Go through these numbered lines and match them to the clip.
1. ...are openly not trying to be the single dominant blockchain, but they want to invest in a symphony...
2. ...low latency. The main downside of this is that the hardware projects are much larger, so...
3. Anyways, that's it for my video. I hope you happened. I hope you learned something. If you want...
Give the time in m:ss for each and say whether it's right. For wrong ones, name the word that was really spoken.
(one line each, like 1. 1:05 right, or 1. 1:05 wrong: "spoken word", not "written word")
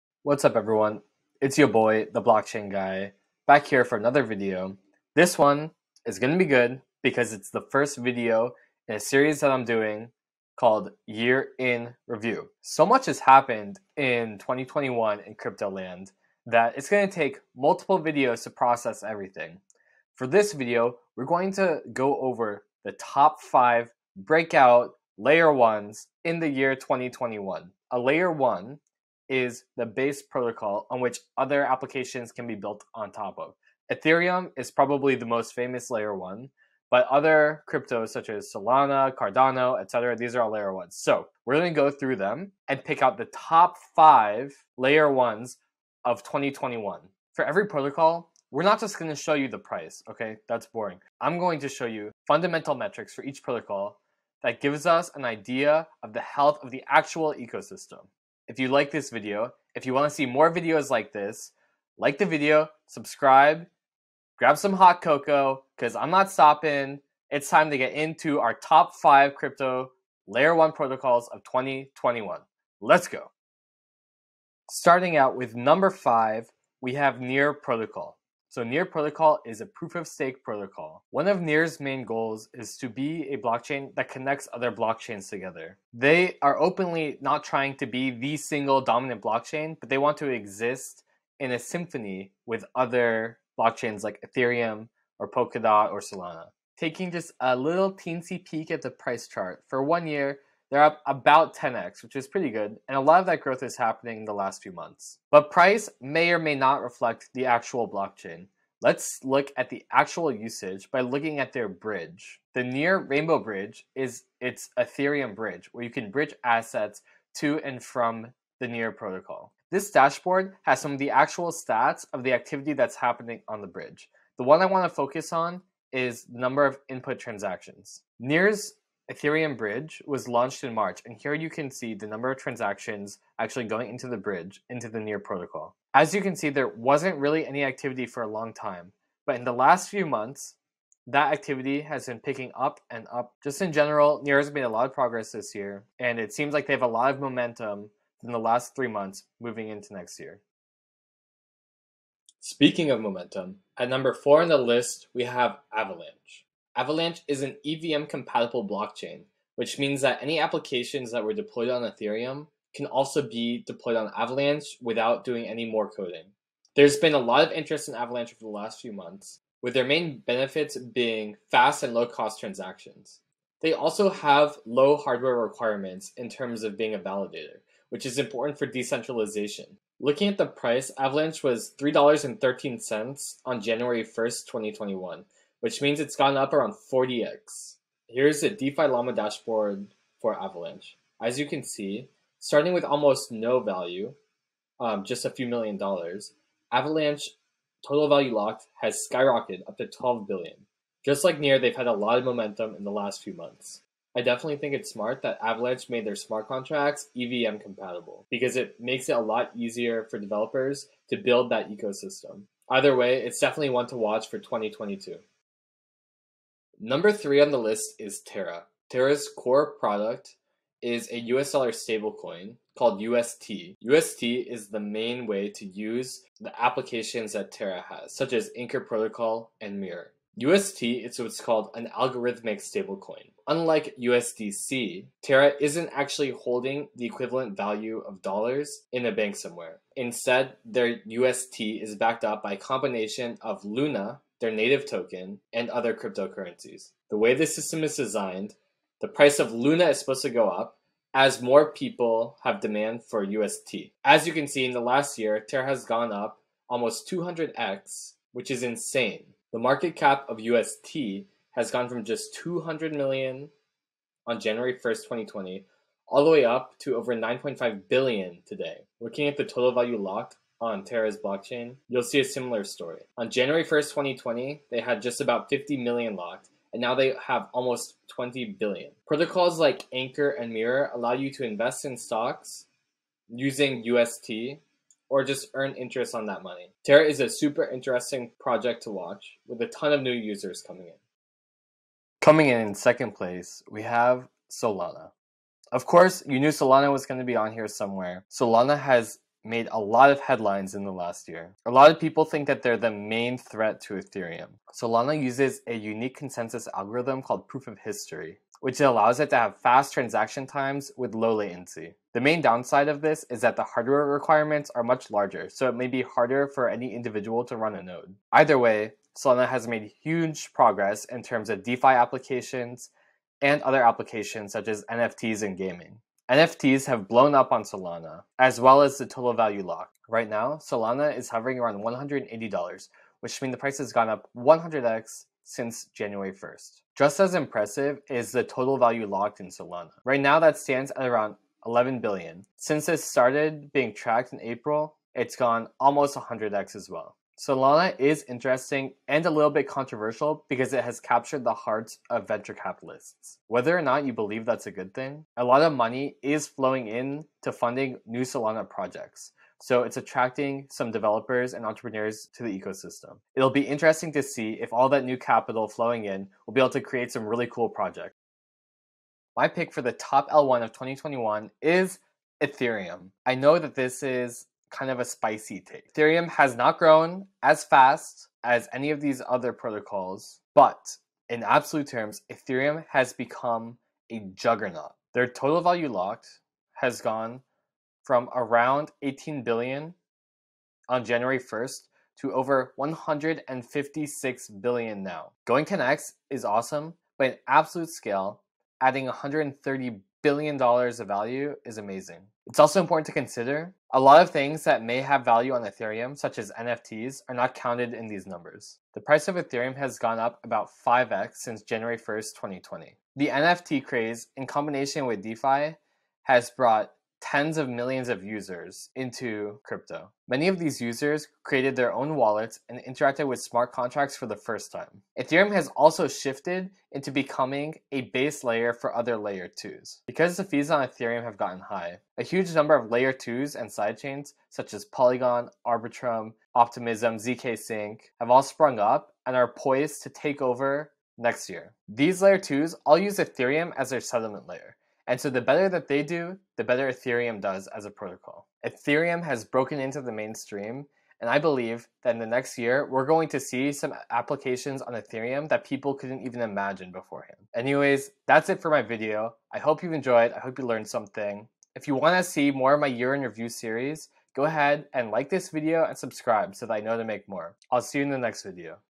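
1. 1:26 wrong: "exist", not "invest"
2. 5:11 wrong: "requirements", not "projects"
3. 7:37 wrong: "enjoyed", not "happened".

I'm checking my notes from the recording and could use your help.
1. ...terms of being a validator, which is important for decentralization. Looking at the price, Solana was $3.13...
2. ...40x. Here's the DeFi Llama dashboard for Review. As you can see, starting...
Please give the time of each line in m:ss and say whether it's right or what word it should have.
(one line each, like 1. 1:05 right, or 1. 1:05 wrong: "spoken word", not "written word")
1. 2:56 wrong: "Avalanche", not "Solana"
2. 3:06 wrong: "Avalanche", not "Review".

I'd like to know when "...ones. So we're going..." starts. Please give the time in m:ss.
0:40.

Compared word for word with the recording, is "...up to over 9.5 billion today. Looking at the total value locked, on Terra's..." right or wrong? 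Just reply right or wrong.
right.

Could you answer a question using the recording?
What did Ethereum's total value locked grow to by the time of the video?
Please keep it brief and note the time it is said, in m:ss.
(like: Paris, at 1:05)
over 156 billion, at 6:32.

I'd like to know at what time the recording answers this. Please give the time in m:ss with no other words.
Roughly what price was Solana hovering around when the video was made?
5:31.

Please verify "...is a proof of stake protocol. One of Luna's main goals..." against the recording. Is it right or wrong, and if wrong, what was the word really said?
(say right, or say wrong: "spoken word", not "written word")
wrong: "Near", not "Luna".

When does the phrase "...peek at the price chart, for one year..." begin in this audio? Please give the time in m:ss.
1:38.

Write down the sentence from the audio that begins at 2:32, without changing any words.
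Speaking of momentum, at number four on the list, we have Avalanche.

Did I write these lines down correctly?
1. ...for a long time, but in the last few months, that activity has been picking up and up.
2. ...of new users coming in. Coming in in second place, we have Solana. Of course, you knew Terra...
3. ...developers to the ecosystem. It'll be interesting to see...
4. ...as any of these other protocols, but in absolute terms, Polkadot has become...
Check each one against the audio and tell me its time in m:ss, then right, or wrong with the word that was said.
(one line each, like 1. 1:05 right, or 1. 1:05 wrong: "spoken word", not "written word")
1. 2:18 right
2. 4:49 wrong: "Solana", not "Terra"
3. 6:01 wrong: "entrepreneurs", not "developers"
4. 6:18 wrong: "Ethereum", not "Polkadot".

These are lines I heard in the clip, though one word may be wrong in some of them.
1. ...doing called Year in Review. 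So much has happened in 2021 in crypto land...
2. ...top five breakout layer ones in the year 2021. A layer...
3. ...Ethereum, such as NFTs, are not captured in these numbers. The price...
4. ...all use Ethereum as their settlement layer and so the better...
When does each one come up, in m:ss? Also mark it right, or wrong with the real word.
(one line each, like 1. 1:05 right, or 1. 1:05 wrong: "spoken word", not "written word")
1. 0:09 right
2. 0:22 right
3. 6:45 wrong: "counted", not "captured"
4. 7:22 right.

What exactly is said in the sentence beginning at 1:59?
This dashboard has some of the actual stats of the activity that's happening on the bridge.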